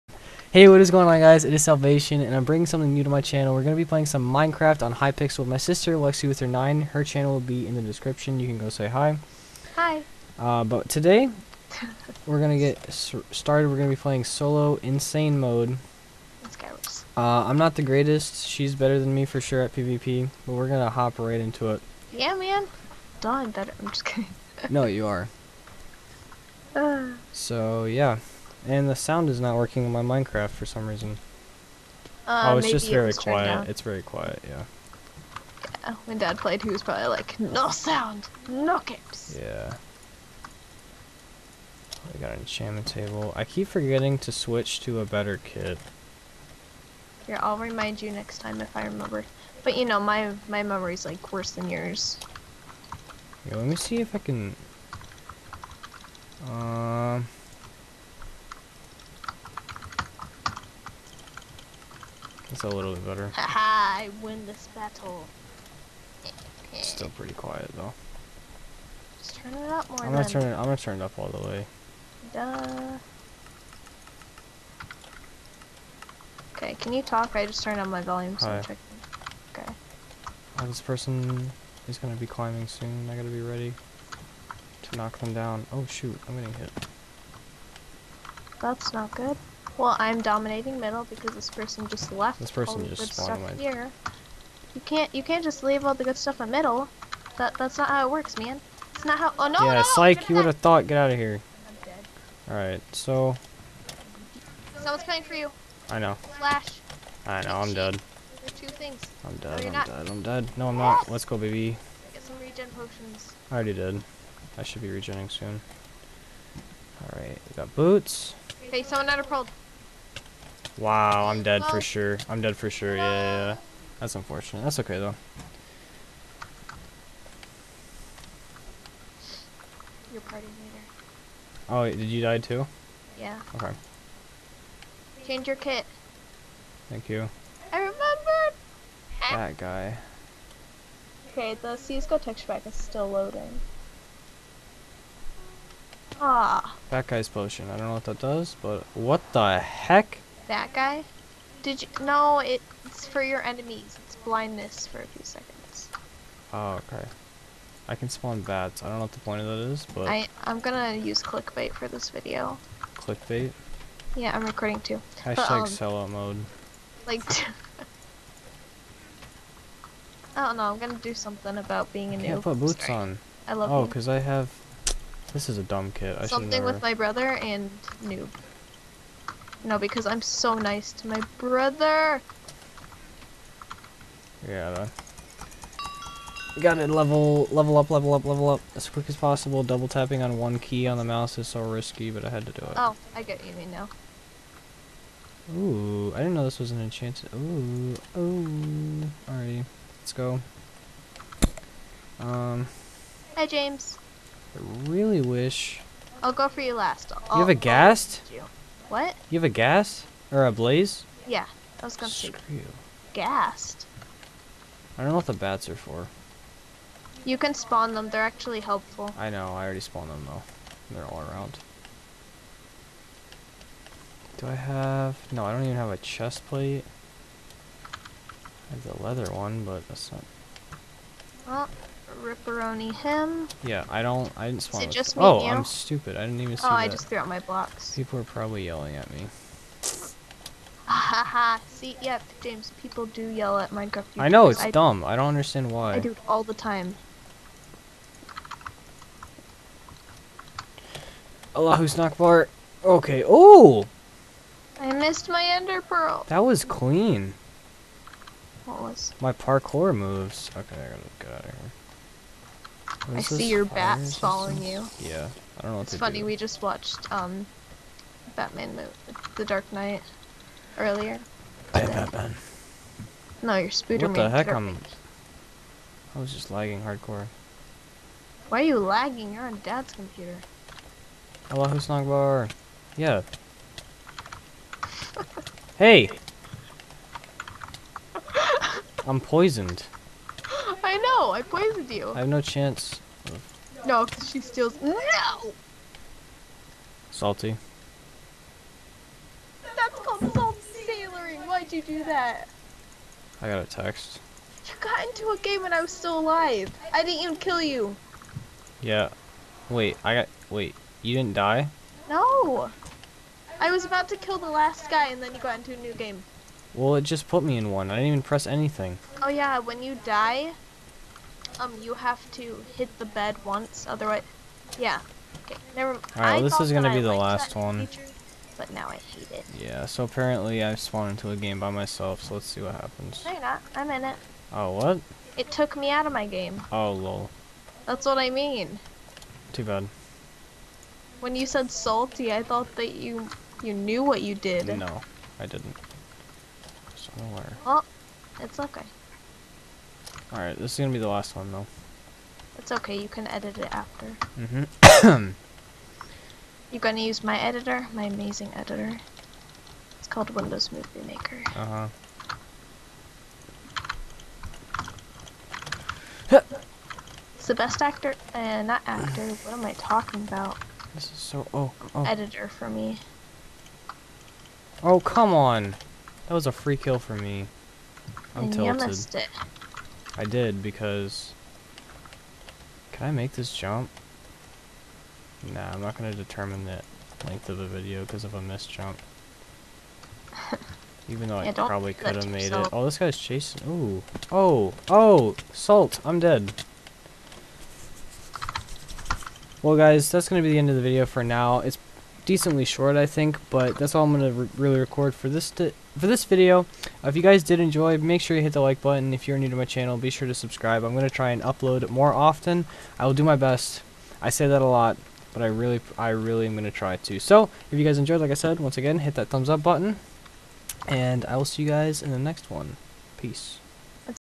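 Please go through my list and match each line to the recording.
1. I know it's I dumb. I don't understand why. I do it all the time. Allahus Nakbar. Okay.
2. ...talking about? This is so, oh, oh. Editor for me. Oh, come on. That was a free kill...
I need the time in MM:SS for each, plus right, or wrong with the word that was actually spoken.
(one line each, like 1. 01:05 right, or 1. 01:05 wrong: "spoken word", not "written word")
1. 04:04 right
2. 06:09 right.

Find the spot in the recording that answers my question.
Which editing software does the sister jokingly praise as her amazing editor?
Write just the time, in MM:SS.
06:00.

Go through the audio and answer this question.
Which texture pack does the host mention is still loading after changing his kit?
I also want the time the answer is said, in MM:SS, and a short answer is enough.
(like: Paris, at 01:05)
CS:GO texture pack, at 02:21.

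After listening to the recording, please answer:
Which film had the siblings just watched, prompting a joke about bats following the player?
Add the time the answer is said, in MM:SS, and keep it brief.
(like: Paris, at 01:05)
The Dark Knight, at 04:28.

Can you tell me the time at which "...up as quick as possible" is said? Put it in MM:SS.
03:08.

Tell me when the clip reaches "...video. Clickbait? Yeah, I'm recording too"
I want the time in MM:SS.
02:42.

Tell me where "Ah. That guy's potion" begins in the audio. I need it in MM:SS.
02:26.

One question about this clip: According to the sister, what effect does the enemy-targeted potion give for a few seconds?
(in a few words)
blindness.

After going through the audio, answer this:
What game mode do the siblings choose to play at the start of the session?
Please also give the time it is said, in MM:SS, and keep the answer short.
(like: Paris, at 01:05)
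solo insane mode, at 00:14.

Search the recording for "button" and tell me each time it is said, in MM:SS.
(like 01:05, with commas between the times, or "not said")
06:48, 06:59.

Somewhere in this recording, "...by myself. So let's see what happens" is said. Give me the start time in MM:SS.
05:31.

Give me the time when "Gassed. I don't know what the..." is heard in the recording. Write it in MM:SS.
03:33.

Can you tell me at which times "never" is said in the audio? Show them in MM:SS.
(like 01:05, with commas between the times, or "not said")
02:56, 05:25.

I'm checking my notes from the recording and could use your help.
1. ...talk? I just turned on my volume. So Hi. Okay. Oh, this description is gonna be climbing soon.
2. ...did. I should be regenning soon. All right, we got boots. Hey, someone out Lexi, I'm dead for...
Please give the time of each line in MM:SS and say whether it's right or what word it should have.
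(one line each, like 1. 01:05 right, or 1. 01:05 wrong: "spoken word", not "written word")
1. 01:17 wrong: "person", not "description"
2. 01:53 wrong: "Wow", not "Lexi".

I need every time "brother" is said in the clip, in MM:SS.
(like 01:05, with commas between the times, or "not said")
02:56, 03:01.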